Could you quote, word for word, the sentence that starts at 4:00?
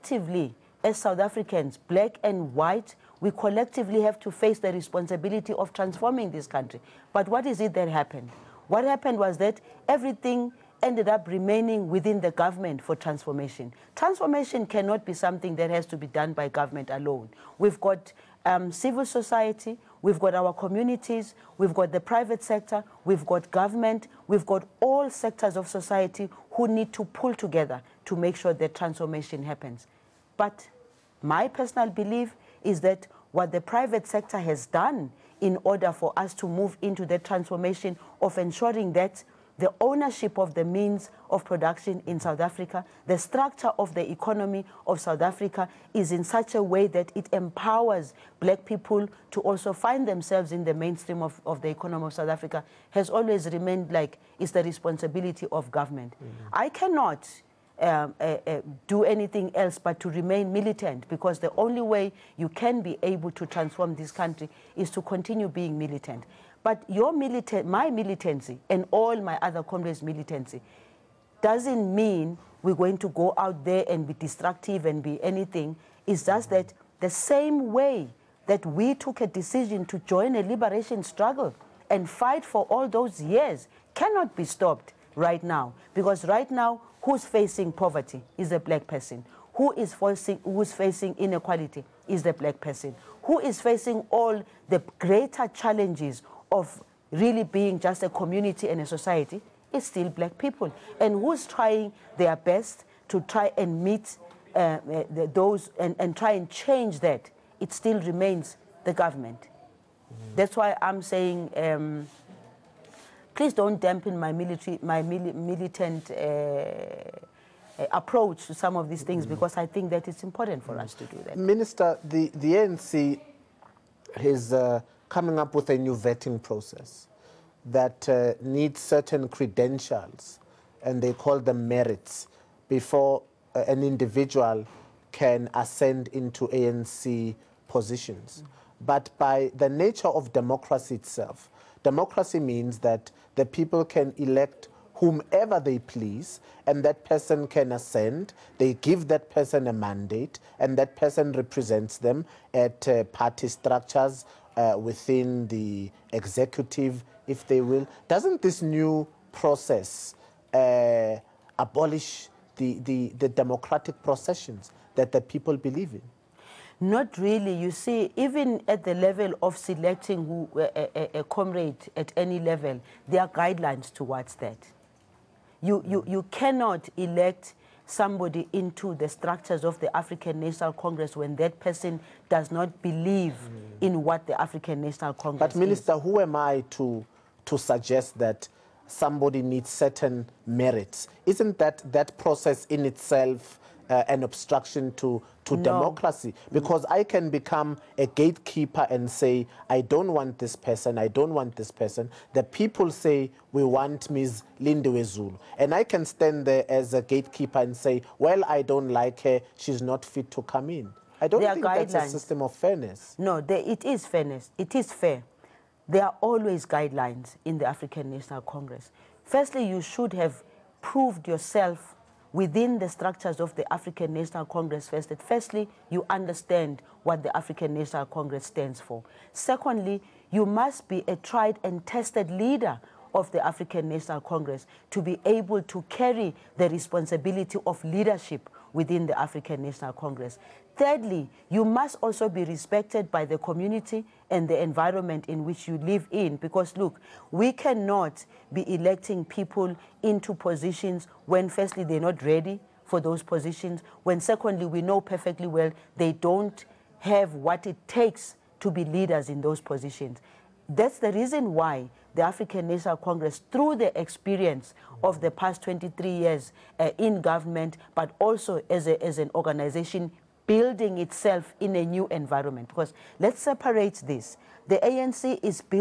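Thirdly, you must also be respected by the community and the environment in which you live in.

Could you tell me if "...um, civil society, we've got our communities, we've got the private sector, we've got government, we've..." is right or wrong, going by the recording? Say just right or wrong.
right.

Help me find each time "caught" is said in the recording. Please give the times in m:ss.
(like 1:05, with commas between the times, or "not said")
not said.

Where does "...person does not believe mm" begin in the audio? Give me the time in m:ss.
3:01.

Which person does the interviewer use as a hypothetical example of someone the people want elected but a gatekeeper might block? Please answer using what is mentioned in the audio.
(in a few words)
Lindiwe Zulu.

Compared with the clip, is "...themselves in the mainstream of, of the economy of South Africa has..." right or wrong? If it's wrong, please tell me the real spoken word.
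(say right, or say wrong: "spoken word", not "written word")
right.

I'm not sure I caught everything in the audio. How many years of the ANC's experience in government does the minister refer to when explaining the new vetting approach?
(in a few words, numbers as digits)
23.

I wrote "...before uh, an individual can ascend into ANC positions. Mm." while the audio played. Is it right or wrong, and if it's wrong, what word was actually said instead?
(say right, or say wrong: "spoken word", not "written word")
right.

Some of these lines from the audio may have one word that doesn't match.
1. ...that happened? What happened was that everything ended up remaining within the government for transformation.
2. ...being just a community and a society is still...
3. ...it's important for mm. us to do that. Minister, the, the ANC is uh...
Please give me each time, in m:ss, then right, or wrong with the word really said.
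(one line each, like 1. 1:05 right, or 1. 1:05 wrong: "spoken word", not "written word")
1. 0:07 right
2. 1:37 right
3. 2:00 right.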